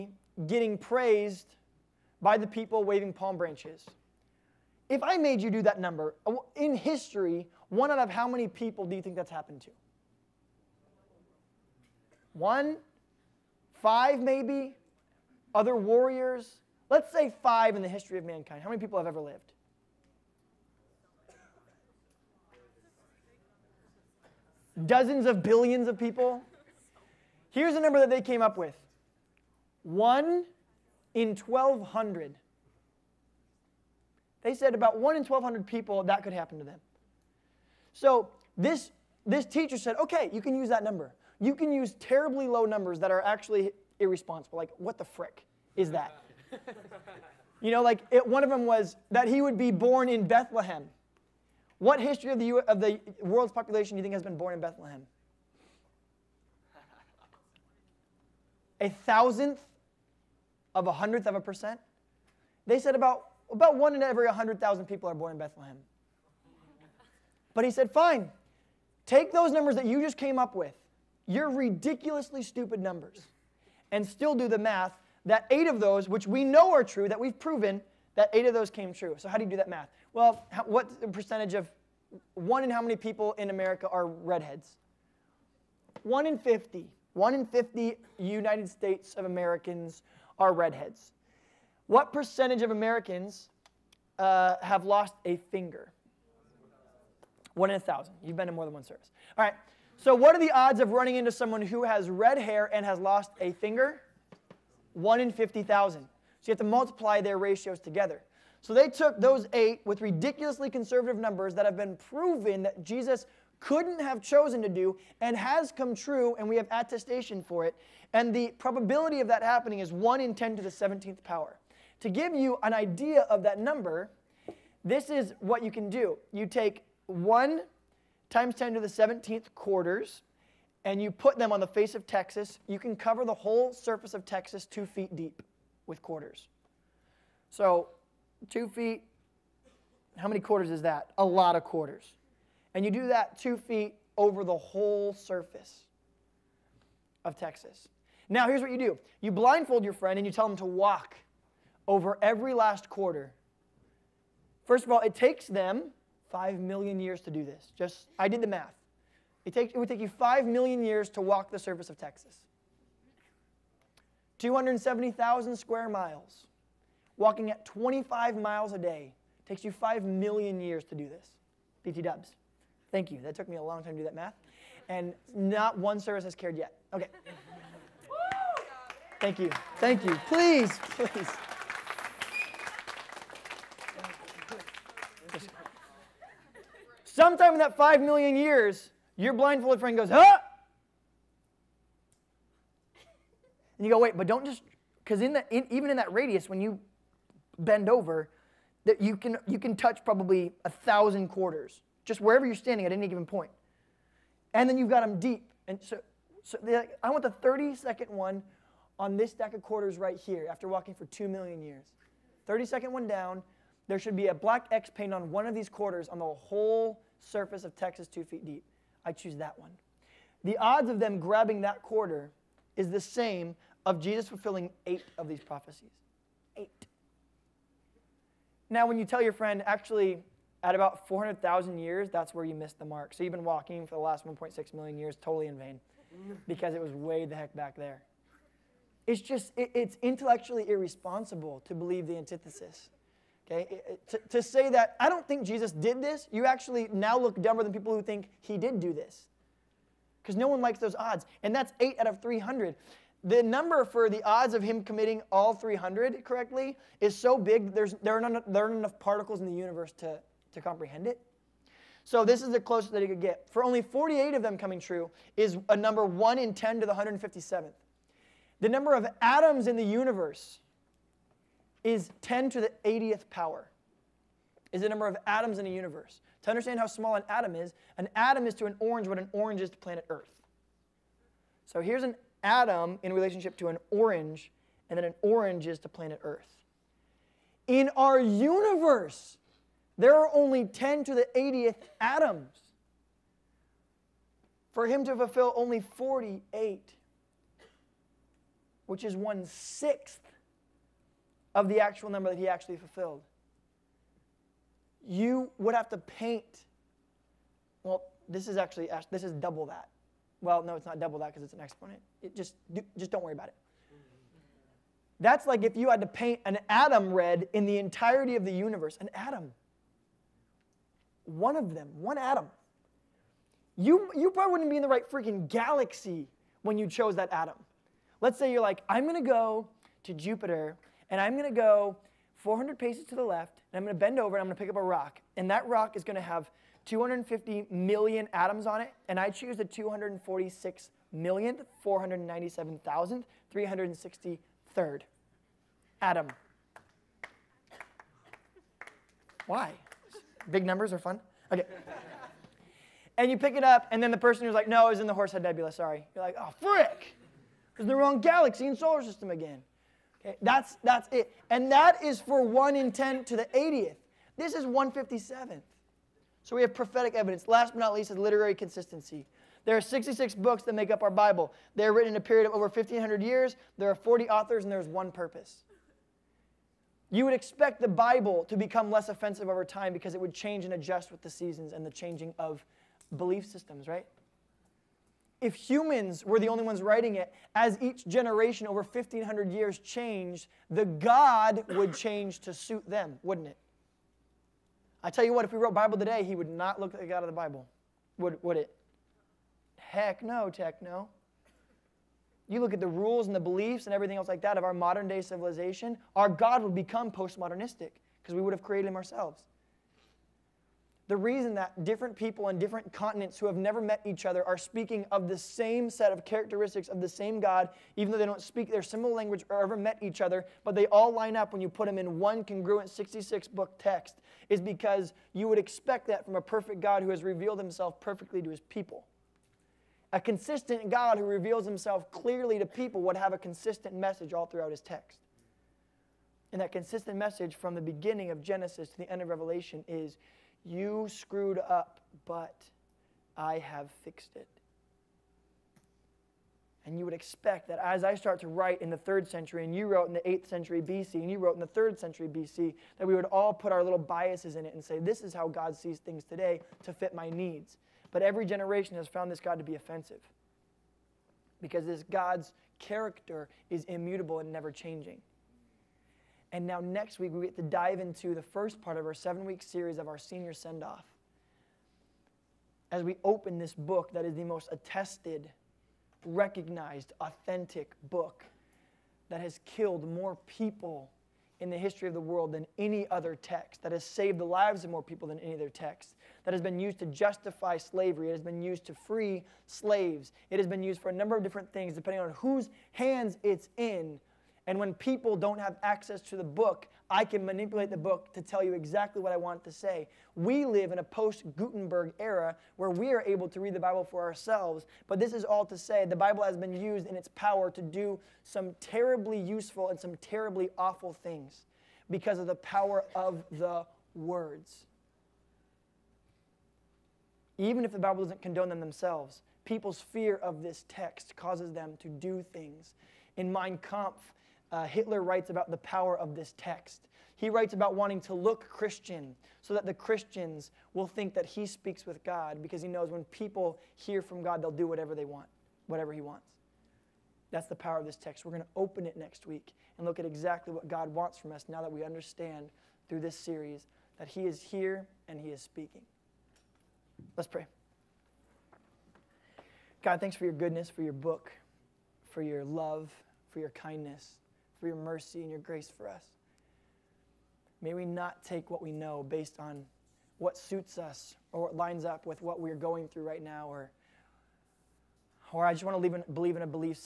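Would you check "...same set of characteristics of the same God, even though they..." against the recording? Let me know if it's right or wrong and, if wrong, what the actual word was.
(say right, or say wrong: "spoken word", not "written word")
right.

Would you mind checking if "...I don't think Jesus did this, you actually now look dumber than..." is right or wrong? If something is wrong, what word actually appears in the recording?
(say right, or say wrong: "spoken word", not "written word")
right.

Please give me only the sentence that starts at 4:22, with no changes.
So this is the closest that he could get.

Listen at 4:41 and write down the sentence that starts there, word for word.
So here's an atom in relationship to an orange, and then an orange is to planet Earth.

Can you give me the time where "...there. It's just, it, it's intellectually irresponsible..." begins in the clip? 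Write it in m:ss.
3:57.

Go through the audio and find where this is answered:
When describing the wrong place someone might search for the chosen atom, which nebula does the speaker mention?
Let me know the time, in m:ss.
5:55.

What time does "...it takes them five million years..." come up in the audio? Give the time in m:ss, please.
2:34.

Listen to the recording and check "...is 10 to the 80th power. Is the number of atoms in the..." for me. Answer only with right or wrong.
right.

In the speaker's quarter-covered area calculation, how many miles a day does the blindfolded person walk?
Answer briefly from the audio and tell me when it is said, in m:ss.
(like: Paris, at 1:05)
25, at 2:47.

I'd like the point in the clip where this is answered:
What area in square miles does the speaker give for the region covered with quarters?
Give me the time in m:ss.
2:44.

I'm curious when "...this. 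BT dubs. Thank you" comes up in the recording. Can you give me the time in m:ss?
2:51.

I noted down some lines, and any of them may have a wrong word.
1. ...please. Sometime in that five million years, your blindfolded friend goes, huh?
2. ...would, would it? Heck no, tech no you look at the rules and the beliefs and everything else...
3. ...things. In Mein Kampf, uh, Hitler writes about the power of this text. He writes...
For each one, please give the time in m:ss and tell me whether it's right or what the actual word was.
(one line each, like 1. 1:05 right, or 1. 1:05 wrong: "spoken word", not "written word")
1. 3:00 right
2. 6:38 right
3. 8:42 right.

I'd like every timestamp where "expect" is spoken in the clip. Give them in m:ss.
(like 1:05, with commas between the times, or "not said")
6:17, 7:05, 7:27.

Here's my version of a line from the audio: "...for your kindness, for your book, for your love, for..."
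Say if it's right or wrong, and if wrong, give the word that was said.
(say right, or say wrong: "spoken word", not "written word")
wrong: "goodness", not "kindness".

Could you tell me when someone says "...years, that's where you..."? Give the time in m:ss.
3:51.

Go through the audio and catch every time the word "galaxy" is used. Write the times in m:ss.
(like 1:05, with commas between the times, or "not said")
5:25, 5:58.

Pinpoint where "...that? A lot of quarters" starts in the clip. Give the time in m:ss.
2:20.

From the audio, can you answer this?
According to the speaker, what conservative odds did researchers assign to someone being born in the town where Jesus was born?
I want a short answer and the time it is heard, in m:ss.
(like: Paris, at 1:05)
1 in 100,000, at 1:03.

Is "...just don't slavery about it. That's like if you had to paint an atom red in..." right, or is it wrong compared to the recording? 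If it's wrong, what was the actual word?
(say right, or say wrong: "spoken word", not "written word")
wrong: "worry", not "slavery".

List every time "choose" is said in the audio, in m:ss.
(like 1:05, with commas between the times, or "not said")
3:39, 5:39.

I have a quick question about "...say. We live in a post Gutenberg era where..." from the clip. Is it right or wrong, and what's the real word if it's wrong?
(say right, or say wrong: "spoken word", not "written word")
right.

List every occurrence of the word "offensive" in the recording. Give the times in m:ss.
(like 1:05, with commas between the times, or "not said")
6:19, 7:39.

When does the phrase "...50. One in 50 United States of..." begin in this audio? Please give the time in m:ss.
1:26.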